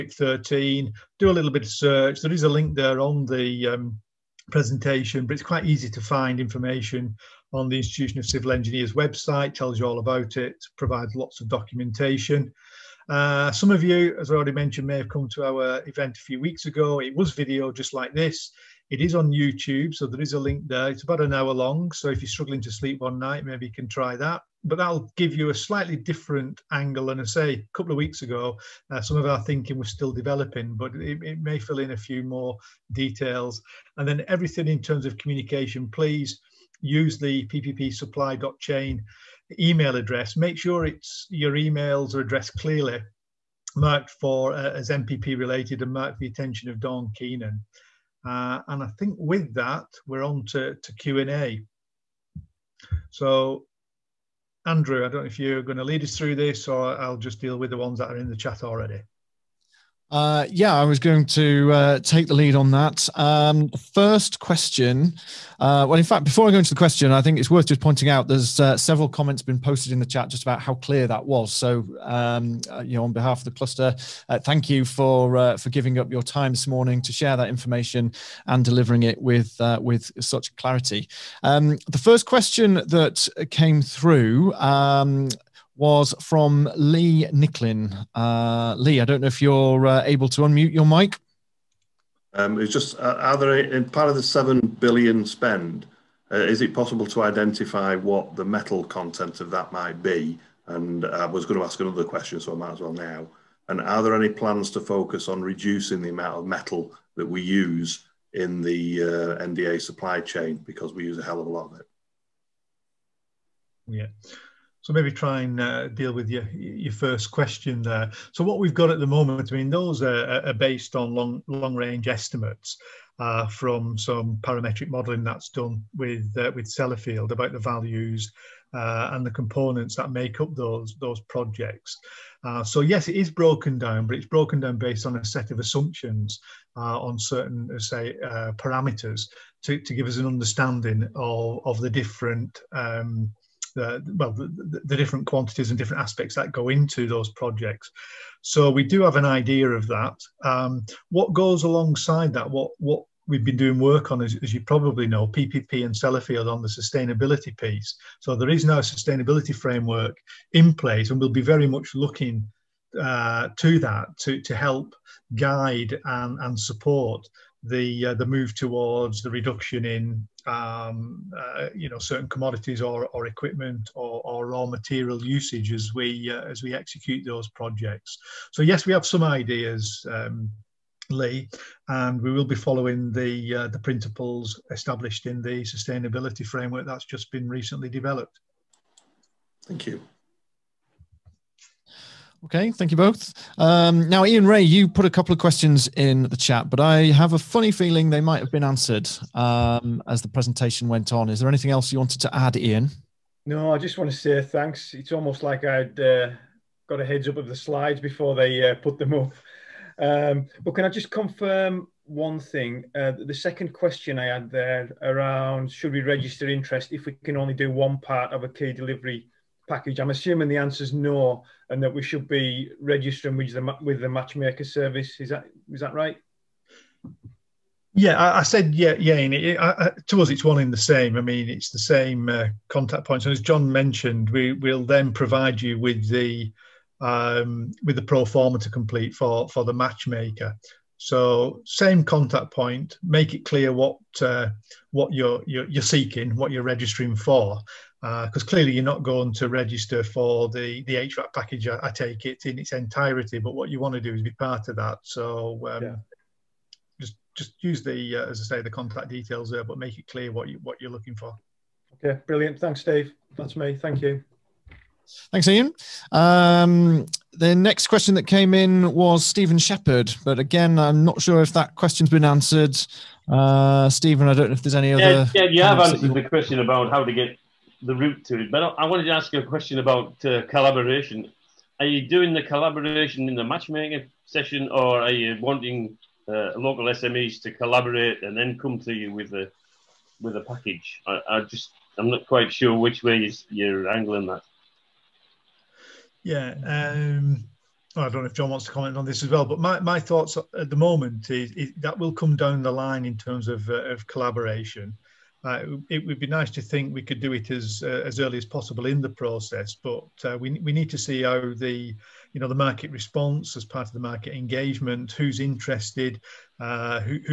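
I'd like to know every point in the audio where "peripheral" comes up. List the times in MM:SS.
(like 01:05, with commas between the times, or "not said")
not said.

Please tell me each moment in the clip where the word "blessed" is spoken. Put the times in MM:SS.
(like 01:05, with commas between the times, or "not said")
not said.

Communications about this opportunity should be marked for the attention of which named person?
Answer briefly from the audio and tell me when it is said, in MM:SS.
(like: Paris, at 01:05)
Don Keenan, at 00:46.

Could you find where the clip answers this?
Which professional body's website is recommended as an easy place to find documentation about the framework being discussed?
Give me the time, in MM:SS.
00:07.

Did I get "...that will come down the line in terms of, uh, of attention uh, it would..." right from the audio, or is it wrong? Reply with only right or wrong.
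wrong.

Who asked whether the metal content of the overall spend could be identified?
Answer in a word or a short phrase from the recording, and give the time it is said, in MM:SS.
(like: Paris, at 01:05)
Lee Nicklin, at 01:26.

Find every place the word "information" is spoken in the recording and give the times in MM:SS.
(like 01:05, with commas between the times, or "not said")
00:06, 01:17.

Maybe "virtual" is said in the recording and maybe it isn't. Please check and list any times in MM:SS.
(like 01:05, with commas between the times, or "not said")
not said.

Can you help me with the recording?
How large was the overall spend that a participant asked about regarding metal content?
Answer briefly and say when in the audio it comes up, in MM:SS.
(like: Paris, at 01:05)
7 billion, at 01:34.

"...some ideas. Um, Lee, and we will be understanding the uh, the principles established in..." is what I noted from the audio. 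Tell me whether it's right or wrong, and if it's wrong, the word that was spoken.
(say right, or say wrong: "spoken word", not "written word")
wrong: "following", not "understanding".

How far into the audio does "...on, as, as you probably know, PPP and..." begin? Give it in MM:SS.
02:34.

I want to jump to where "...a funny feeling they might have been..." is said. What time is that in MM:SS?
03:17.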